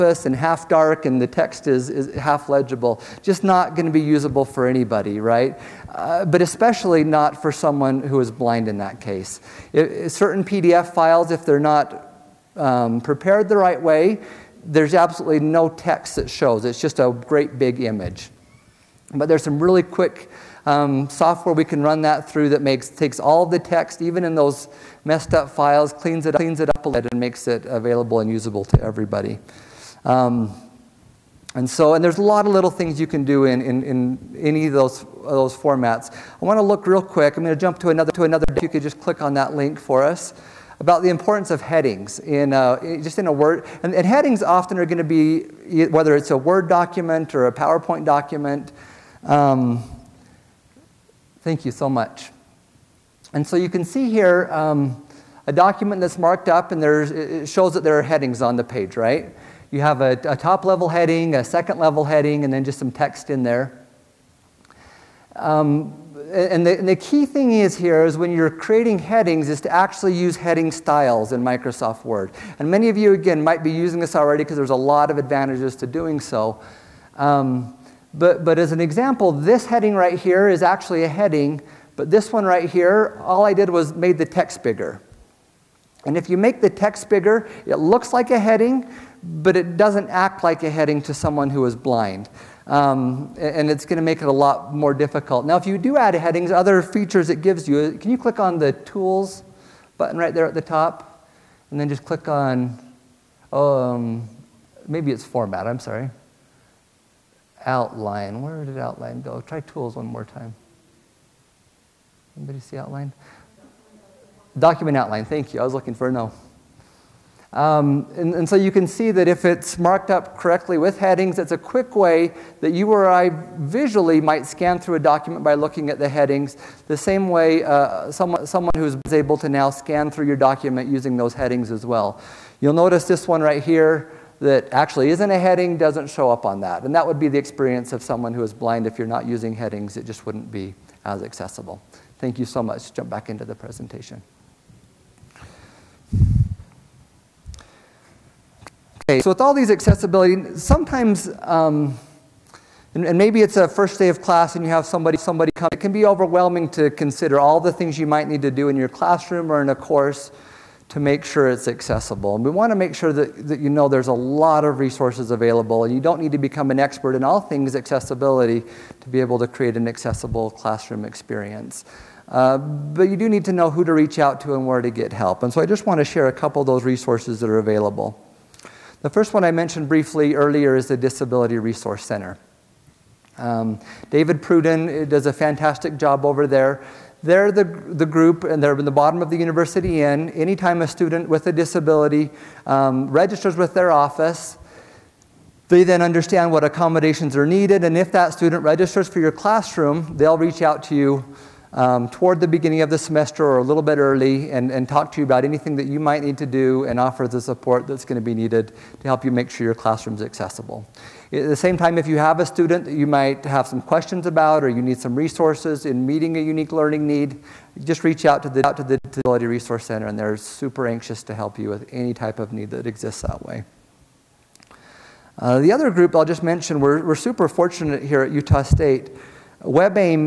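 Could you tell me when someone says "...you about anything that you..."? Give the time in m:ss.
3:25.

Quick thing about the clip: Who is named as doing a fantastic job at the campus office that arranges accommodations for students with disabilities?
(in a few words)
David Pruden.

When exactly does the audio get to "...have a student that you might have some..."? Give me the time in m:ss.
3:32.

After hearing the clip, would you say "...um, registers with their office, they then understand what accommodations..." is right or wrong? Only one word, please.
right.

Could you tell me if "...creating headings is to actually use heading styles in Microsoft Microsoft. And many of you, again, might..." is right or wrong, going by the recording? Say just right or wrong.
wrong.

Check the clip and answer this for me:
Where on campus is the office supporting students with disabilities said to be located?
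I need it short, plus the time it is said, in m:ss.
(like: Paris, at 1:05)
Bottom of the University Inn, at 3:08.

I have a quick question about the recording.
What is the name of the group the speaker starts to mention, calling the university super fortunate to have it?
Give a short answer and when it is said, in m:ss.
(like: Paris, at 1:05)
WebAIM, at 3:49.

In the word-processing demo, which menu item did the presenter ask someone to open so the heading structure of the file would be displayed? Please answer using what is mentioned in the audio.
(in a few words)
Document outline.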